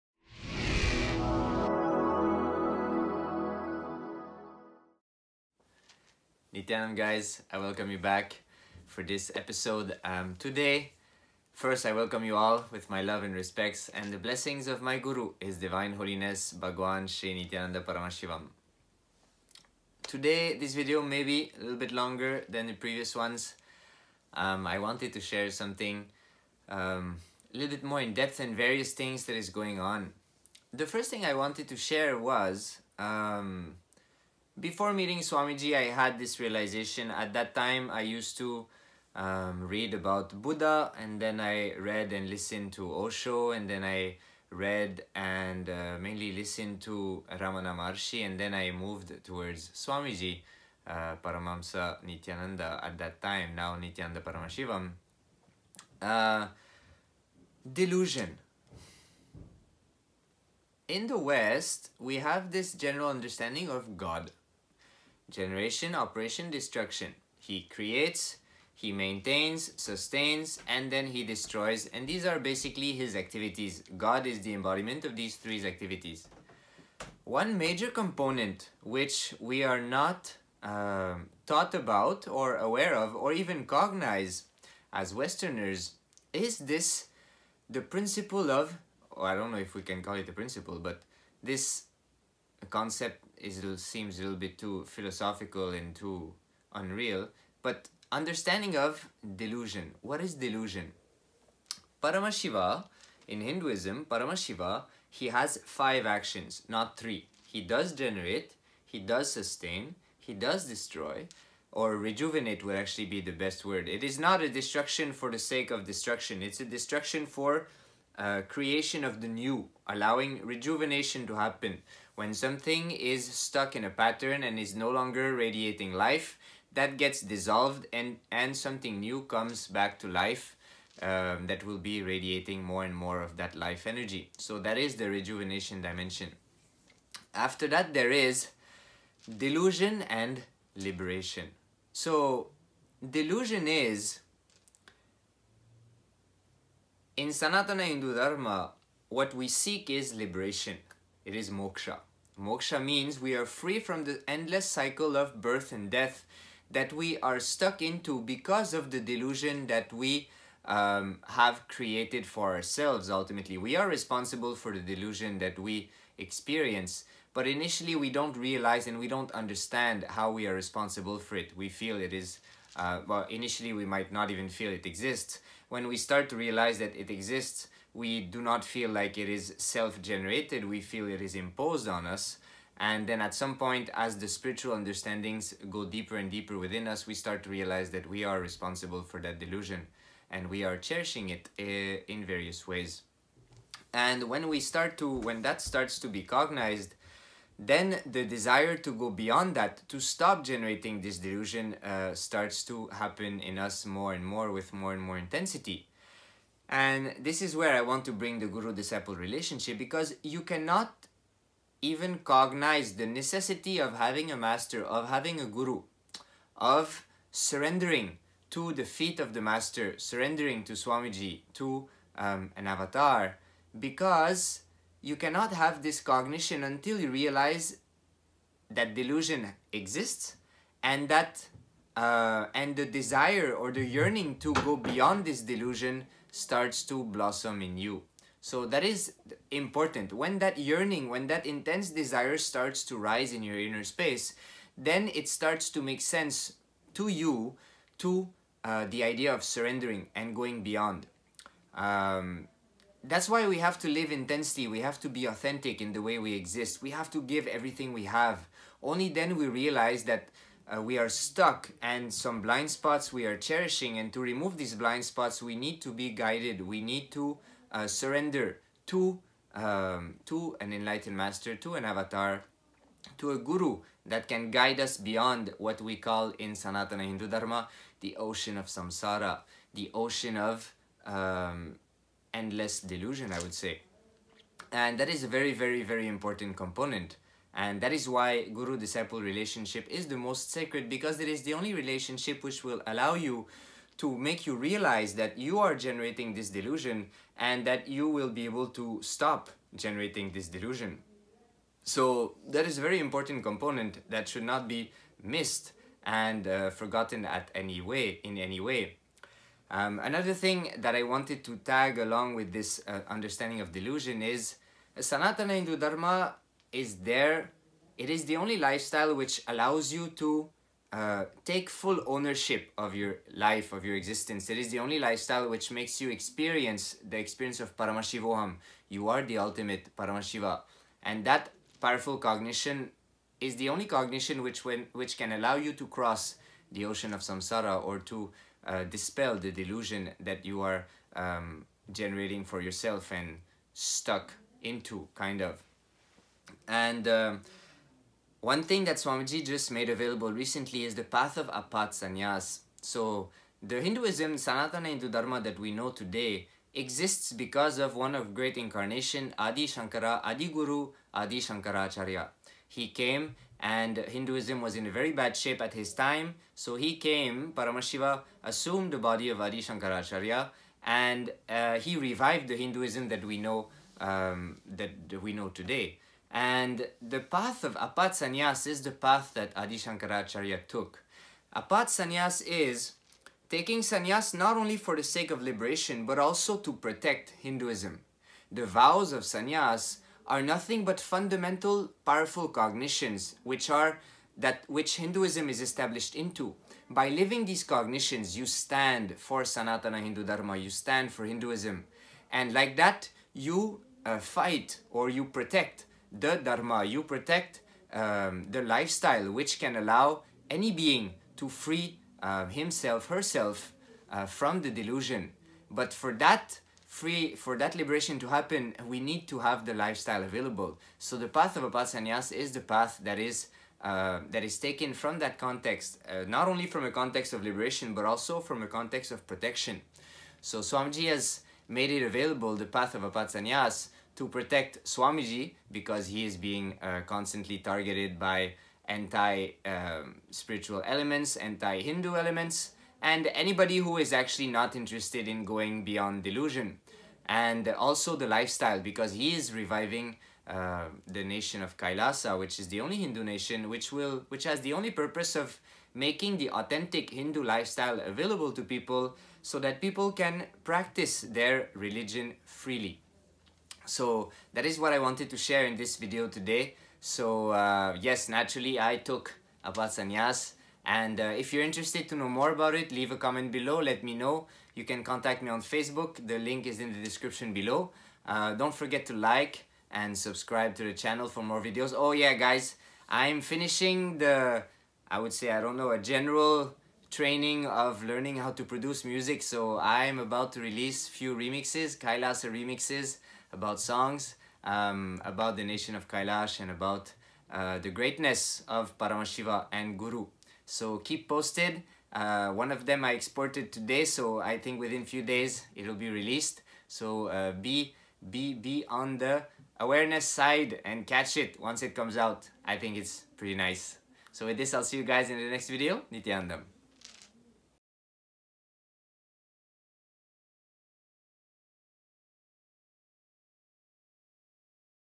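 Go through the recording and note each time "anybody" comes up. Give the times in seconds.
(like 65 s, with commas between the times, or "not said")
443 s.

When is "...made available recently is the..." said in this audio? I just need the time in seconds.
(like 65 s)
349 s.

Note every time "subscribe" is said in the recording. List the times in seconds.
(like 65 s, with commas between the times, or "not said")
480 s.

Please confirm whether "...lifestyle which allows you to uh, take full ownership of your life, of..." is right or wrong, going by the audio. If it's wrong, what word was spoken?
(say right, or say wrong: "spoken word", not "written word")
right.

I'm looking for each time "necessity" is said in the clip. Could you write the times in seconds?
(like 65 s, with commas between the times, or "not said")
213 s.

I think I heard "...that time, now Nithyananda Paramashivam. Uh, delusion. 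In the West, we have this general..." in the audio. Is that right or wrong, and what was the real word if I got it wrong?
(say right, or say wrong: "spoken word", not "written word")
right.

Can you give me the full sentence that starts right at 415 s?
But for that free, for that liberation to happen, we need to have the lifestyle available.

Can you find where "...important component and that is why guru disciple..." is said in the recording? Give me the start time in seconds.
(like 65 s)
286 s.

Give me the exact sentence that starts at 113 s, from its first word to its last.
It is not a destruction for the sake of destruction.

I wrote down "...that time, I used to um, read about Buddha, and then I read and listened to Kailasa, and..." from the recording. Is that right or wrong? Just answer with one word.
wrong.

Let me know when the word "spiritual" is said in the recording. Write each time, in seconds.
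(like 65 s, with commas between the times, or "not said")
184 s, 438 s.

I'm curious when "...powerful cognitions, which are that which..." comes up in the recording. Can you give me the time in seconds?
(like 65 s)
392 s.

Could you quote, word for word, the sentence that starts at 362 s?
He came and Hinduism was in a very bad shape at his time.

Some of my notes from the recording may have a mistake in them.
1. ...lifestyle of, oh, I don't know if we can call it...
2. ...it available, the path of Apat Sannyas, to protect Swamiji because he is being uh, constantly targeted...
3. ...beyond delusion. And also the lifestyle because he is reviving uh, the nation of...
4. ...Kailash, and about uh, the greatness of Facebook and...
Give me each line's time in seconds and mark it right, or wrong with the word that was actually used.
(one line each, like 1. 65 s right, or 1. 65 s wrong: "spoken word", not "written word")
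1. 87 s wrong: "principle", not "lifestyle"
2. 431 s right
3. 445 s right
4. 496 s wrong: "Paramashiva", not "Facebook".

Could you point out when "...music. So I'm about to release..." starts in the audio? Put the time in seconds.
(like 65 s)
489 s.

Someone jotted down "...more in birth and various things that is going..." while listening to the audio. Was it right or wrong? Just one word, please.
wrong.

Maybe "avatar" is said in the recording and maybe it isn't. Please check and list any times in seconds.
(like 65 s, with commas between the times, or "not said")
222 s, 271 s.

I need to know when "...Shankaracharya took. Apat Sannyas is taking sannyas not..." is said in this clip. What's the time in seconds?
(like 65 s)
379 s.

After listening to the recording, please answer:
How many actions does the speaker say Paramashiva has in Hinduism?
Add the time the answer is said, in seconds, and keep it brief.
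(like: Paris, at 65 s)
5, at 105 s.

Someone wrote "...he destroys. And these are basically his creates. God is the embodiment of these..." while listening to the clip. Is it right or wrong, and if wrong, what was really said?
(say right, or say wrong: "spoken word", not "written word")
wrong: "activities", not "creates".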